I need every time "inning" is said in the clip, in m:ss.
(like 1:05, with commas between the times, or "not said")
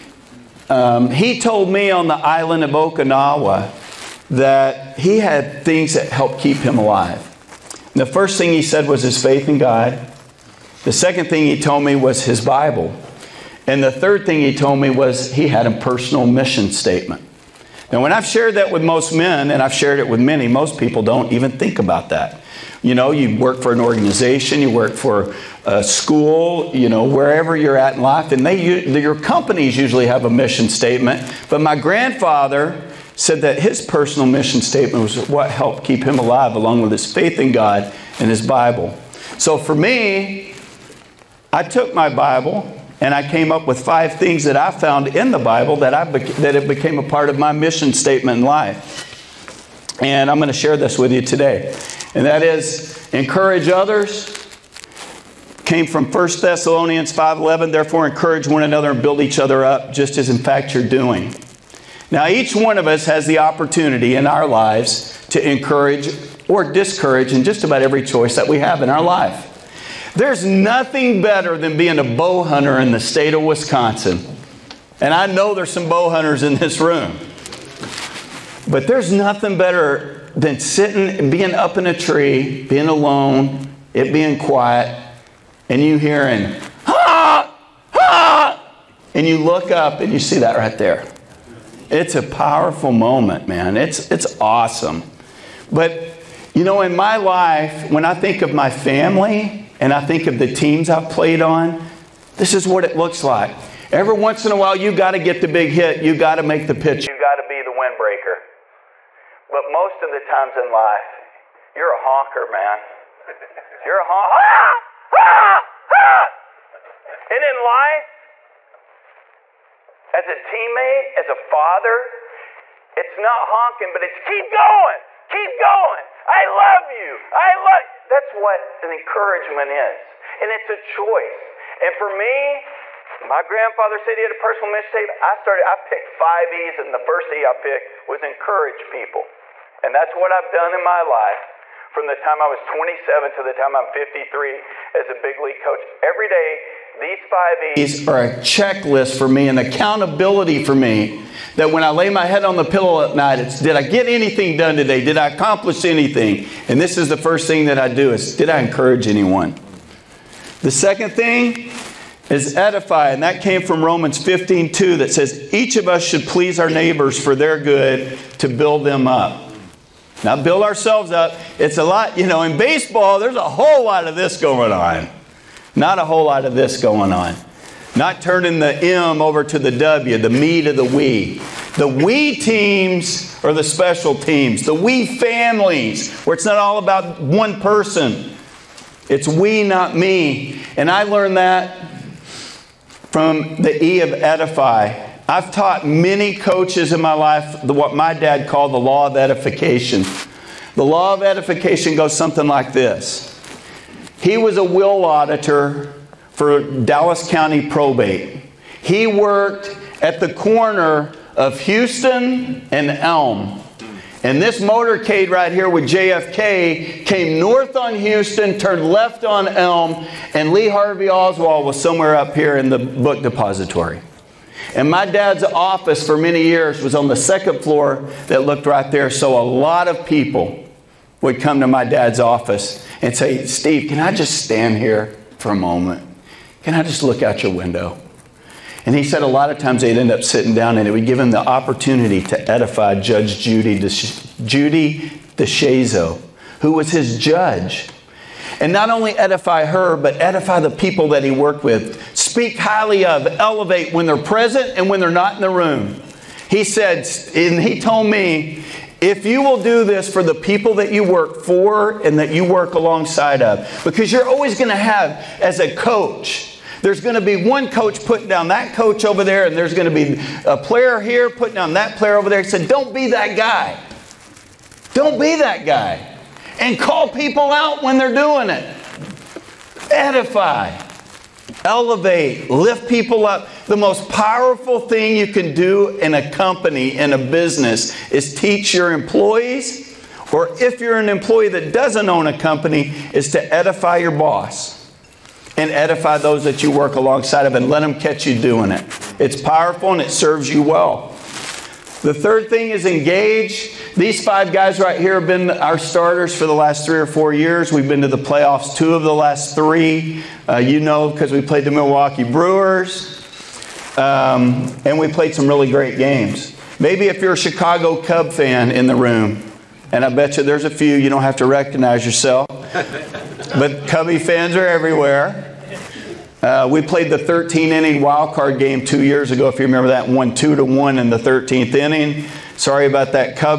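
5:27, 5:31.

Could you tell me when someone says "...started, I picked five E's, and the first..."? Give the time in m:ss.
2:15.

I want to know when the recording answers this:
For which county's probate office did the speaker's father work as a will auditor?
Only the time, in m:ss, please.
3:26.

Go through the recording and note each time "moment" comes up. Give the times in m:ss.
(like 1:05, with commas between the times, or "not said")
1:32, 3:55.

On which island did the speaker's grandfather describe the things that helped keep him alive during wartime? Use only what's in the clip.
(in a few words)
Okinawa.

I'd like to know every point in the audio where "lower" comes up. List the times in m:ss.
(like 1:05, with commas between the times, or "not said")
not said.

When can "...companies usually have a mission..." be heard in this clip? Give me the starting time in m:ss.
0:29.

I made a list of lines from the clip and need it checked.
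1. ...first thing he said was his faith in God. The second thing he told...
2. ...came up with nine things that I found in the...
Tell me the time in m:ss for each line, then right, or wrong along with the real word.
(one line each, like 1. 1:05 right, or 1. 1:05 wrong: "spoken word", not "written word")
1. 0:08 right
2. 0:43 wrong: "five", not "nine".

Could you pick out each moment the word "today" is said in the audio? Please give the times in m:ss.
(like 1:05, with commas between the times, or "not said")
0:51, 2:34.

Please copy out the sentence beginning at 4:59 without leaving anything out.
It's powerful and it serves you well.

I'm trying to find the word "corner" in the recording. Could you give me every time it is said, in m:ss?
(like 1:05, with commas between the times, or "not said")
3:30.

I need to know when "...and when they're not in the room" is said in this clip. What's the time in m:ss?
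4:14.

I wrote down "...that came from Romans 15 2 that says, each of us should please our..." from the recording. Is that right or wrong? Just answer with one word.
right.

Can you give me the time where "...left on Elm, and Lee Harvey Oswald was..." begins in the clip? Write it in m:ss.
3:38.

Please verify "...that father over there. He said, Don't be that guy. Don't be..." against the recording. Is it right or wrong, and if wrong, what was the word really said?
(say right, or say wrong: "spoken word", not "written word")
wrong: "player", not "father".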